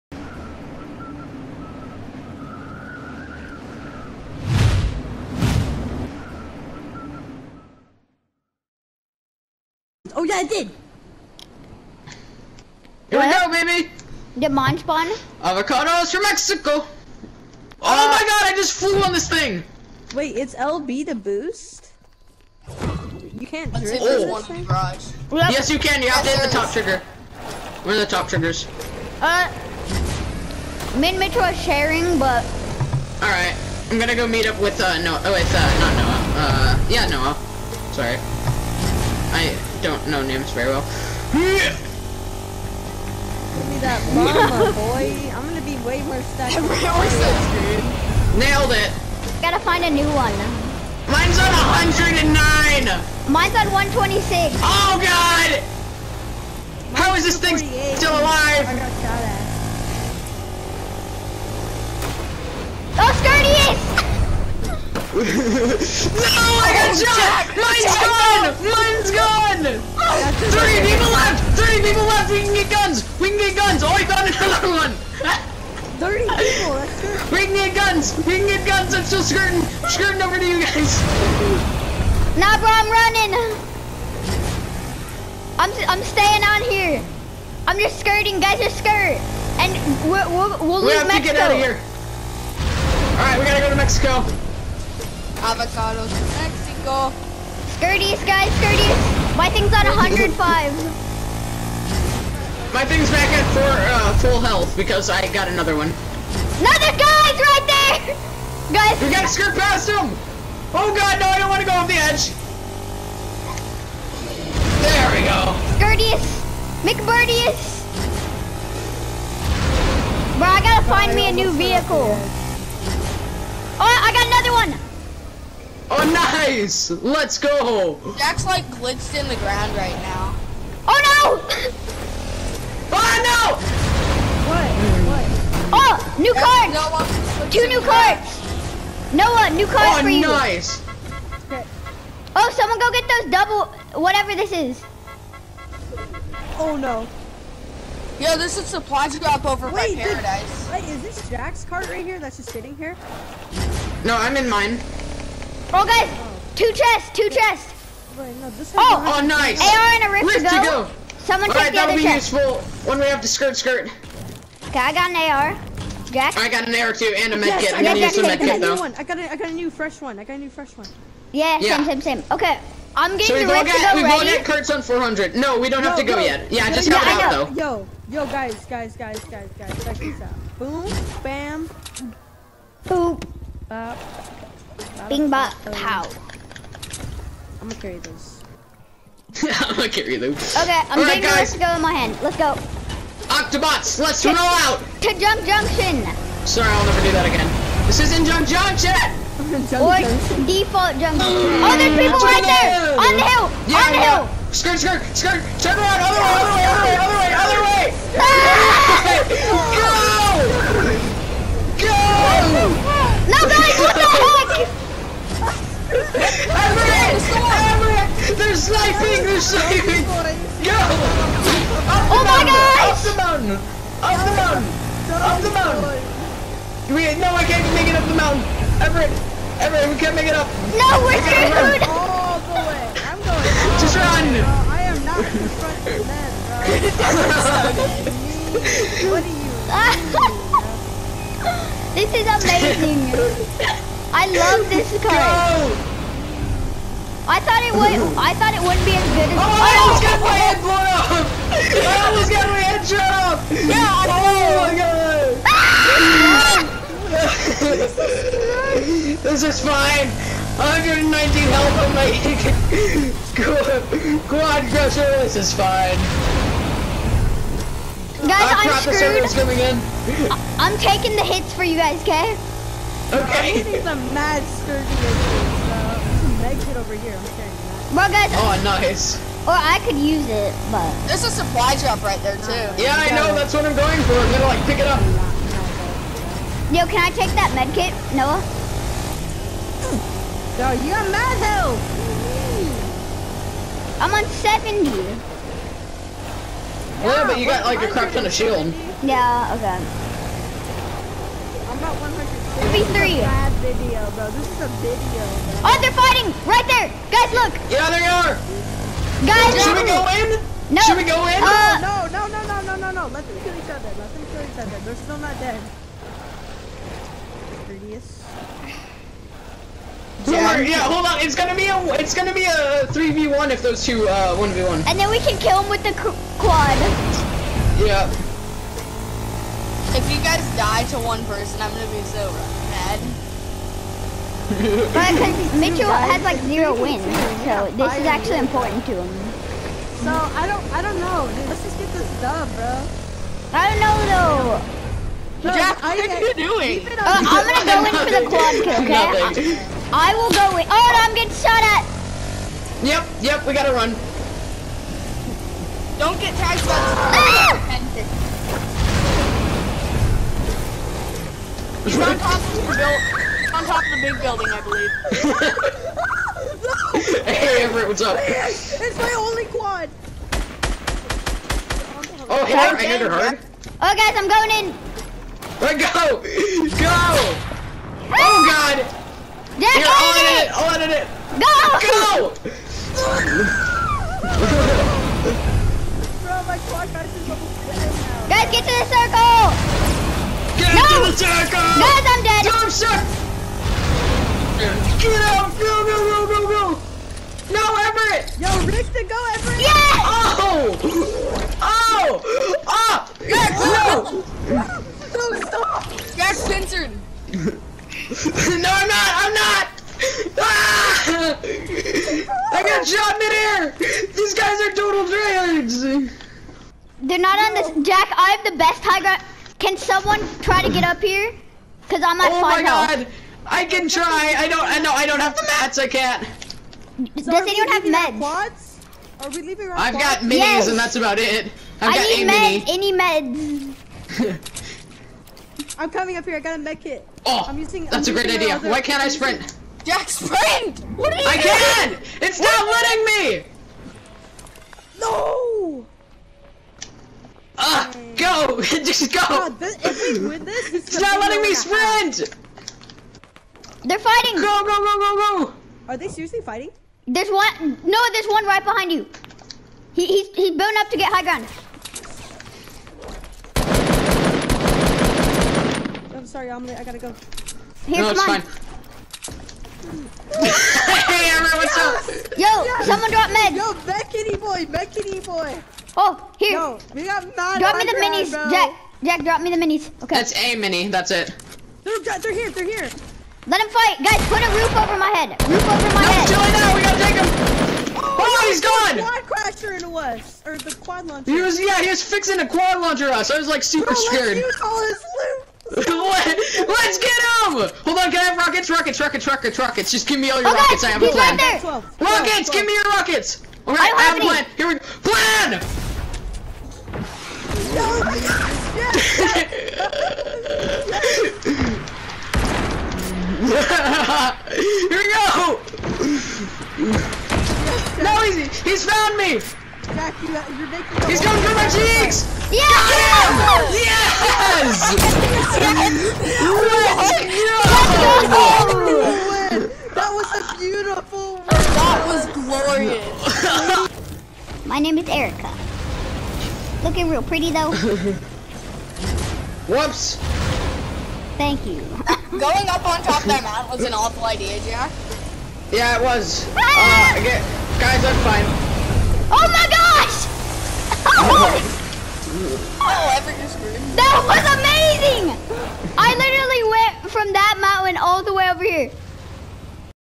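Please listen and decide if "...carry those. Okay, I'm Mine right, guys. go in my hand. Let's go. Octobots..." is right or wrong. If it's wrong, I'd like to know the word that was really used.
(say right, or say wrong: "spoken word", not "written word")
wrong: "All", not "Mine".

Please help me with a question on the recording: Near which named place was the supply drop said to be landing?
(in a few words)
Paradise.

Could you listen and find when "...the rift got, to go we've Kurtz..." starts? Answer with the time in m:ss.
2:53.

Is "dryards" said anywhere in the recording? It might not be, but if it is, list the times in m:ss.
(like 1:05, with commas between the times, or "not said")
6:55.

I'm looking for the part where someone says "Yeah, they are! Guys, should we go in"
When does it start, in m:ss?
5:07.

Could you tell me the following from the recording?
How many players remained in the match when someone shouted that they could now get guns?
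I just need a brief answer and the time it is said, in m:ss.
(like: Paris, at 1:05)
30, at 1:16.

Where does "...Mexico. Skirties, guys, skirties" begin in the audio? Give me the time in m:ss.
1:36.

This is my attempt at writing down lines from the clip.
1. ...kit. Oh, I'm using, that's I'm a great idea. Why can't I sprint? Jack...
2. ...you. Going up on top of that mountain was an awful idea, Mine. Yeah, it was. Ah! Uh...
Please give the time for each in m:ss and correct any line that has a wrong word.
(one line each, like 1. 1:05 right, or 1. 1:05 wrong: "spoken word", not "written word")
1. 7:16 right
2. 9:01 wrong: "Jack", not "Mine".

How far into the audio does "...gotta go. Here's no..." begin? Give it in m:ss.
7:46.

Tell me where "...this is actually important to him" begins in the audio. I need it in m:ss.
5:37.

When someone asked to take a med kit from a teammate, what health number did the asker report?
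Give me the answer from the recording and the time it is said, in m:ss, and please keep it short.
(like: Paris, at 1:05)
70, at 4:54.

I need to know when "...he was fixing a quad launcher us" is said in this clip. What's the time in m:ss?
8:11.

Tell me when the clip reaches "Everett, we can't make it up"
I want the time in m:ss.
3:49.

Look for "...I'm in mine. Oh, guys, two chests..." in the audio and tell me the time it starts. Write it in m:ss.
2:34.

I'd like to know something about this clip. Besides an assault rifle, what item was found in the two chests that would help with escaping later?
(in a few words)
Rift to go.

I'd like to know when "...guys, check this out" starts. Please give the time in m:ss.
2:59.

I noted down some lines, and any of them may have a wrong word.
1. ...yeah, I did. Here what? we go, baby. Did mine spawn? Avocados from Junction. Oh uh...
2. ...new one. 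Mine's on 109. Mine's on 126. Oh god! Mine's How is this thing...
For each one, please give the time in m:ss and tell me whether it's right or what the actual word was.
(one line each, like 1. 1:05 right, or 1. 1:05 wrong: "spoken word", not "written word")
1. 0:10 wrong: "Mexico", not "Junction"
2. 0:49 right.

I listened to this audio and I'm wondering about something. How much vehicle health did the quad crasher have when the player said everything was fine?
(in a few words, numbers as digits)
119.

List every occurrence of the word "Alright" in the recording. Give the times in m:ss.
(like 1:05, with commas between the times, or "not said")
0:33, 1:33, 8:23.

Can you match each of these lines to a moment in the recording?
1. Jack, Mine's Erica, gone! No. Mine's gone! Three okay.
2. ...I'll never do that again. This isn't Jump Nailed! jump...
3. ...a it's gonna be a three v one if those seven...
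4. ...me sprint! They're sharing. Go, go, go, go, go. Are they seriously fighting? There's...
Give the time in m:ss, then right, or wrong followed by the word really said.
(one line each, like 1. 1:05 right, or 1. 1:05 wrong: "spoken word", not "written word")
1. 1:07 wrong: "Jack", not "Erica"
2. 3:16 wrong: "Junction", not "Nailed"
3. 5:21 wrong: "two", not "seven"
4. 7:31 wrong: "fighting", not "sharing".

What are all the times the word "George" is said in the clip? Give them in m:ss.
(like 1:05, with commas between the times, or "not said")
not said.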